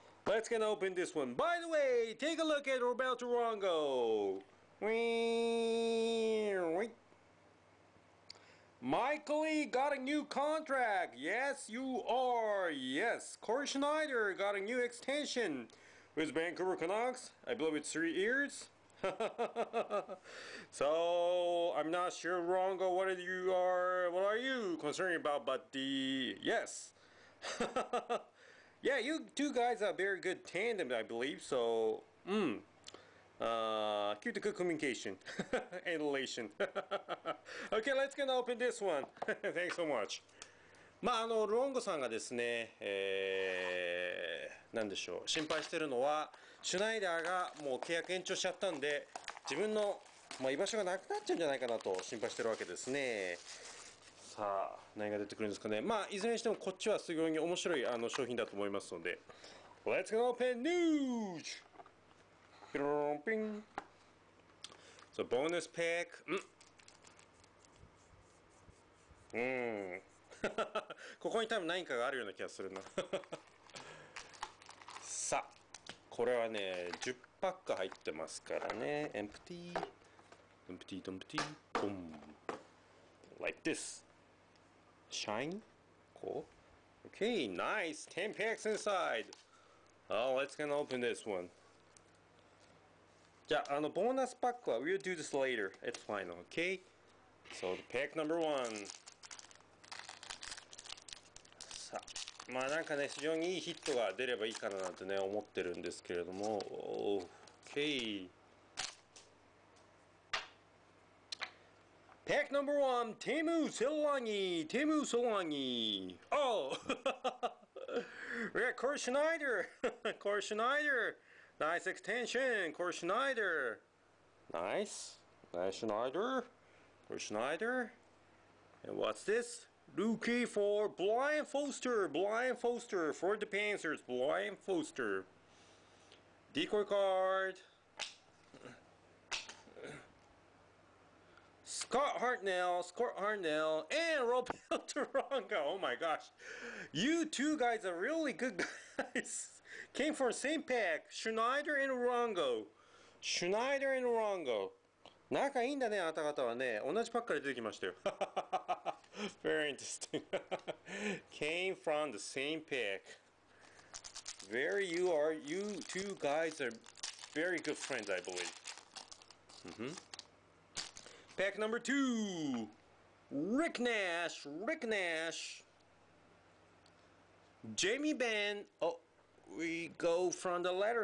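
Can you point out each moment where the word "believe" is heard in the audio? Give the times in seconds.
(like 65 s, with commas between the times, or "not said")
17 s, 31 s, 168 s.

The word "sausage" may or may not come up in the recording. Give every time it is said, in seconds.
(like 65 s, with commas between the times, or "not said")
not said.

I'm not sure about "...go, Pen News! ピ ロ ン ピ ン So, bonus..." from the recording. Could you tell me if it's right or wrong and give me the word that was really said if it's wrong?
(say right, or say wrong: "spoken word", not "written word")
right.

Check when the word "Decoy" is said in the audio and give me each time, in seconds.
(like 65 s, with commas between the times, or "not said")
136 s.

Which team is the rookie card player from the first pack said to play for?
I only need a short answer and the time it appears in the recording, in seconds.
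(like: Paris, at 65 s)
Panthers, at 133 s.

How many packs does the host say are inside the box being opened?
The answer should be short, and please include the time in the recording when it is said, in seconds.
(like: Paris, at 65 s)
10, at 88 s.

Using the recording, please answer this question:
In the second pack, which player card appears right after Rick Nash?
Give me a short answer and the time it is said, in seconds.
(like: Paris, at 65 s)
Jamie Benn, at 177 s.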